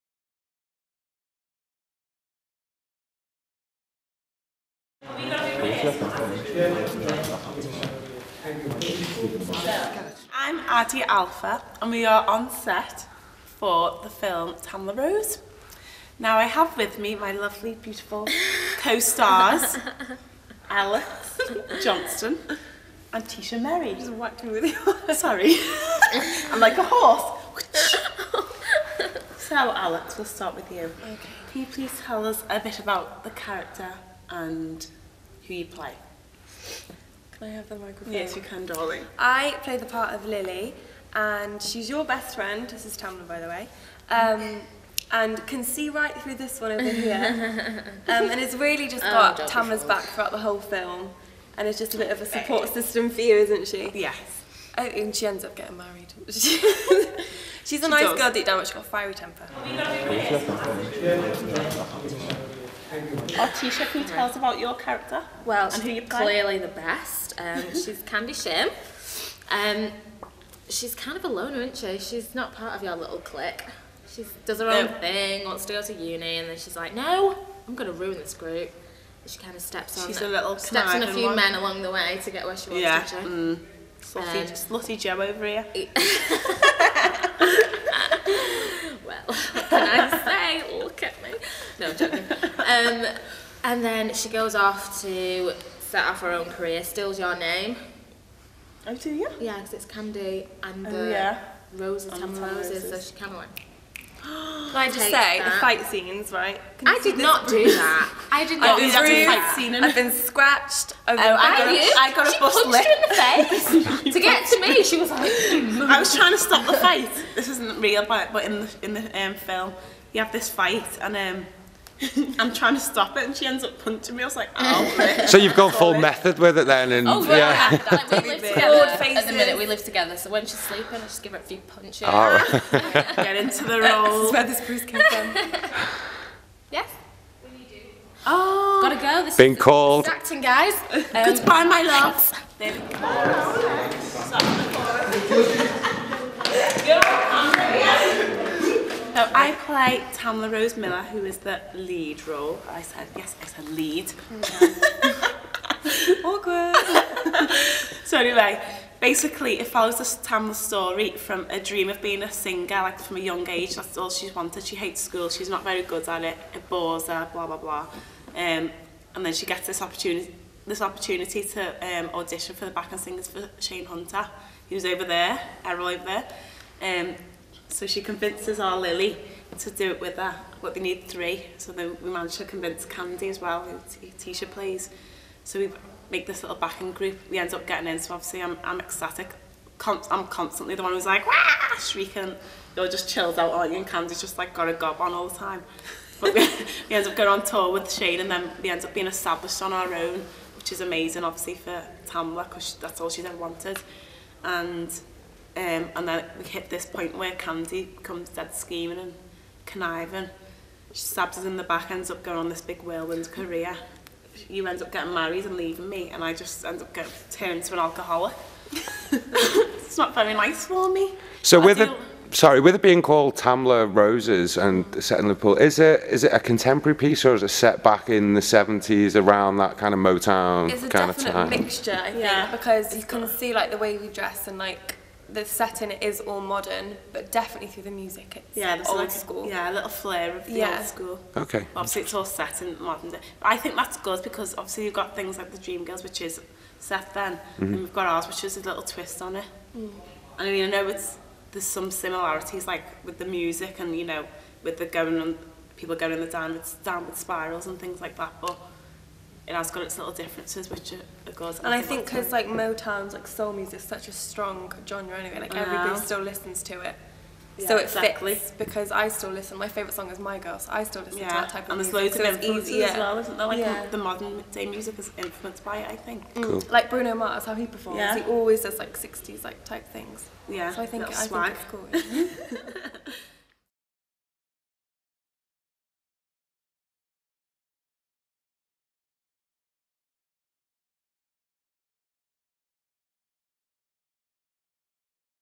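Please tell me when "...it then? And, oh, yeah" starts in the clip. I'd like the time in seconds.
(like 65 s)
126 s.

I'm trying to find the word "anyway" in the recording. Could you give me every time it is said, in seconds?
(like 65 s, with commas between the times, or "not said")
158 s, 265 s.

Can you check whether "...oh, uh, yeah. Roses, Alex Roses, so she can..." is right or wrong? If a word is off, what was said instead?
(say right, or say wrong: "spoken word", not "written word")
wrong: "Tam", not "Alex".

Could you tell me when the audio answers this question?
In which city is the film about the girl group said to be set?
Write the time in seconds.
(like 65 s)
225 s.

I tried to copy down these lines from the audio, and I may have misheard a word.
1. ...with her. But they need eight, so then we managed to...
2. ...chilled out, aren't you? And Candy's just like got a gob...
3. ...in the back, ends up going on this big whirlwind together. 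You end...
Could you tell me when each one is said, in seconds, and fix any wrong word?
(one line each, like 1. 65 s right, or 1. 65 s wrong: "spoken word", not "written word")
1. 180 s wrong: "three", not "eight"
2. 193 s right
3. 211 s wrong: "career", not "together".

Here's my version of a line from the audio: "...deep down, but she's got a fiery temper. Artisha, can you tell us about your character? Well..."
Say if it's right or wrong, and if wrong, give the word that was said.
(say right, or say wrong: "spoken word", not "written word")
right.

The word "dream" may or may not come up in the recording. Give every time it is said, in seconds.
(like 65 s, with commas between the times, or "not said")
161 s, 245 s.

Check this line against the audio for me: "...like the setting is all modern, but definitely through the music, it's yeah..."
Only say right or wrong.
right.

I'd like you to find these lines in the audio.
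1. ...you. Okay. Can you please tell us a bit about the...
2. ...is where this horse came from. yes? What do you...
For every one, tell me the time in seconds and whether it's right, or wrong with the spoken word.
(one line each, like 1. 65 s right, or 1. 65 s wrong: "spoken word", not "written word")
1. 30 s right
2. 134 s wrong: "bruise", not "horse".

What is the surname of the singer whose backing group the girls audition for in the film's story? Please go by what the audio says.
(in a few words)
Hunter.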